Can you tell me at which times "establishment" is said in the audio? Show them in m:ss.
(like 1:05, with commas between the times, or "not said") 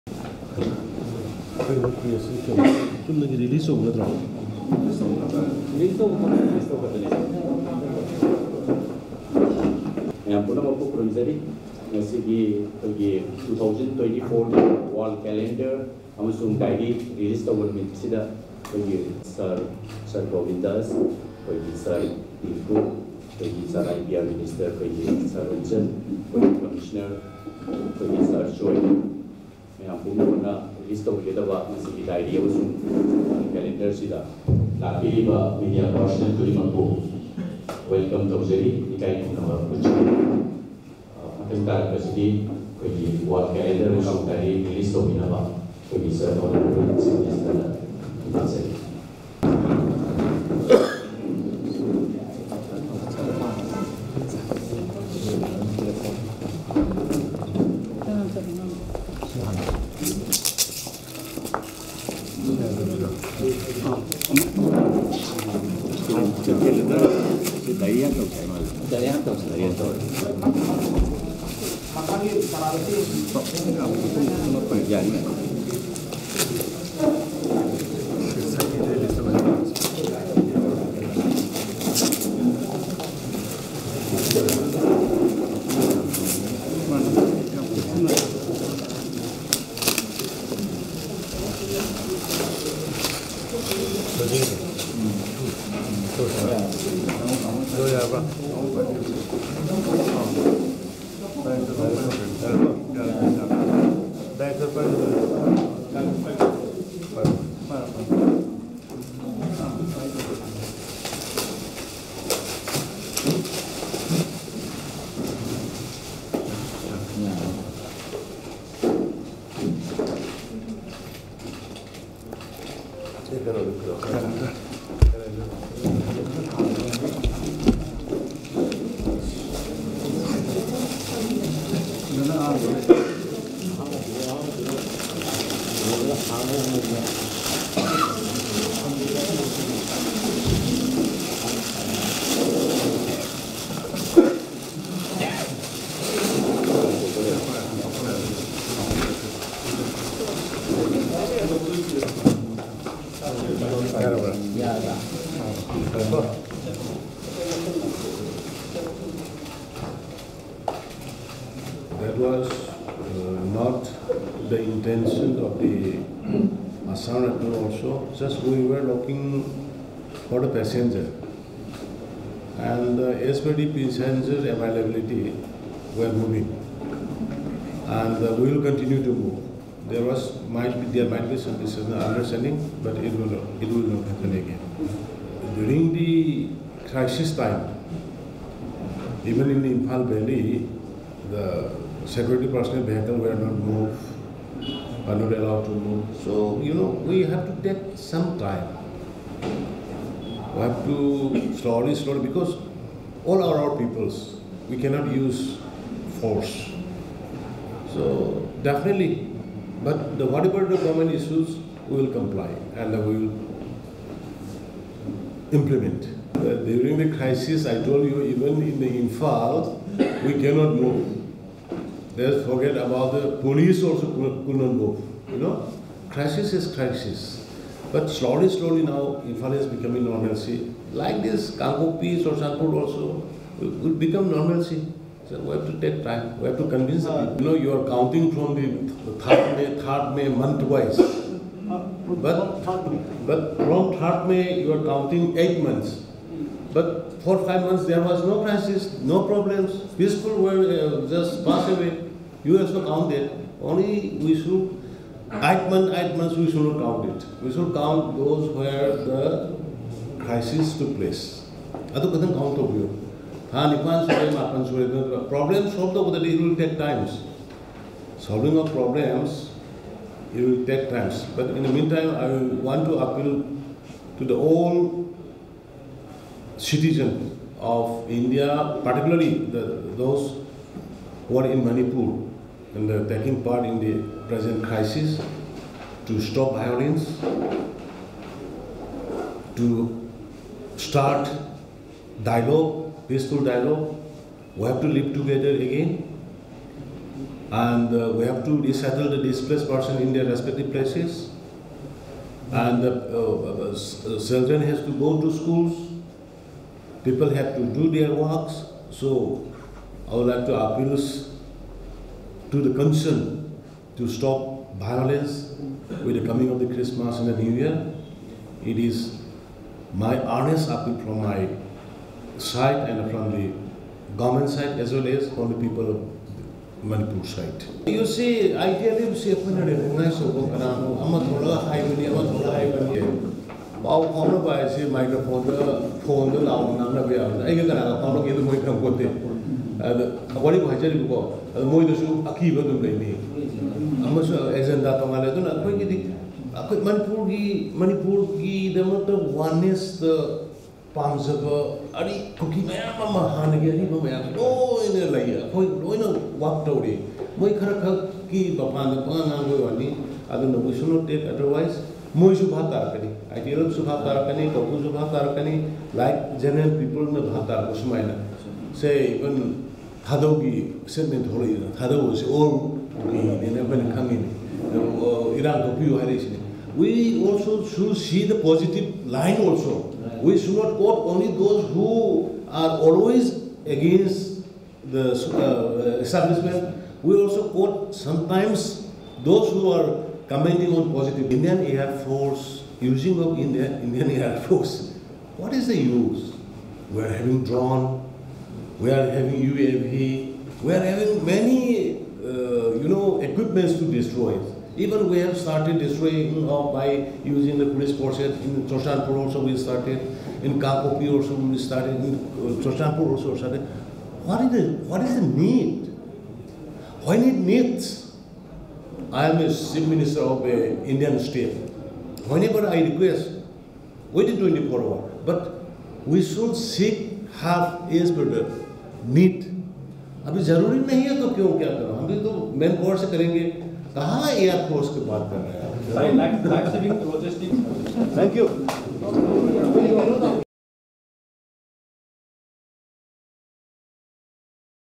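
6:25.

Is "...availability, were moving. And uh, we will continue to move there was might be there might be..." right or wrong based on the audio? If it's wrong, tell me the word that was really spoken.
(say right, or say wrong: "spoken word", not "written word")
right.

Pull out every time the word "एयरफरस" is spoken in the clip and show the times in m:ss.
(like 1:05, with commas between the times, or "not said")
7:14.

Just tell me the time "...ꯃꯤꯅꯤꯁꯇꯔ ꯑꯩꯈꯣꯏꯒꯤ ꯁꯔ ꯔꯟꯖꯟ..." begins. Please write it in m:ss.
0:24.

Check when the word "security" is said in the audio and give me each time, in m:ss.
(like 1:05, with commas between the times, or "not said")
3:12.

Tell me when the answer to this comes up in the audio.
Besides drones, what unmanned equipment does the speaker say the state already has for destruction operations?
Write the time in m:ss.
6:39.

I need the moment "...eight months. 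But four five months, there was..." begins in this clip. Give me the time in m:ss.
4:05.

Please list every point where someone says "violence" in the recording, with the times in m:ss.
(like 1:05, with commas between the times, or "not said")
4:46, 5:14.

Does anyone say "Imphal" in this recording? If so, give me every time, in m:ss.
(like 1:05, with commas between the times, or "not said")
3:09, 3:39, 3:49.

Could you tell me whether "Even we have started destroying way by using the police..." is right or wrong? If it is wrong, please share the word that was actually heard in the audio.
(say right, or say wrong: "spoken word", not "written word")
right.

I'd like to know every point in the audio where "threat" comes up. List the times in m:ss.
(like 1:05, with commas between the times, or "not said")
not said.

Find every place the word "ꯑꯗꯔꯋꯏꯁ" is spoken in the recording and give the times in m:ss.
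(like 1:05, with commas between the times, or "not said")
6:01.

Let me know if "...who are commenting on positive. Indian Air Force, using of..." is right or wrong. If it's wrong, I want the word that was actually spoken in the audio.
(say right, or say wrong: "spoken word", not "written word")
right.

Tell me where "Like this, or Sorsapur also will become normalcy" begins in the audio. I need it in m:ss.
3:50.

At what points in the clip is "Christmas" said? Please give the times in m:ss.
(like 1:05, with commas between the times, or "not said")
5:16.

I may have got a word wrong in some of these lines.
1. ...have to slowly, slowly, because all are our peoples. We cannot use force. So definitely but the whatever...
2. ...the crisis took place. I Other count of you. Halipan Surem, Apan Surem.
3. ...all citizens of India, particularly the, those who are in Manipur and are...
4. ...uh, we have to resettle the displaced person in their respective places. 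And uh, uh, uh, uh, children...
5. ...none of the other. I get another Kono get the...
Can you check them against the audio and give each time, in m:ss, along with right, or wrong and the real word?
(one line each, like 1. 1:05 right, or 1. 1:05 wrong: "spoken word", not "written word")
1. 3:20 right
2. 4:18 right
3. 4:34 right
4. 4:57 right
5. 5:36 right.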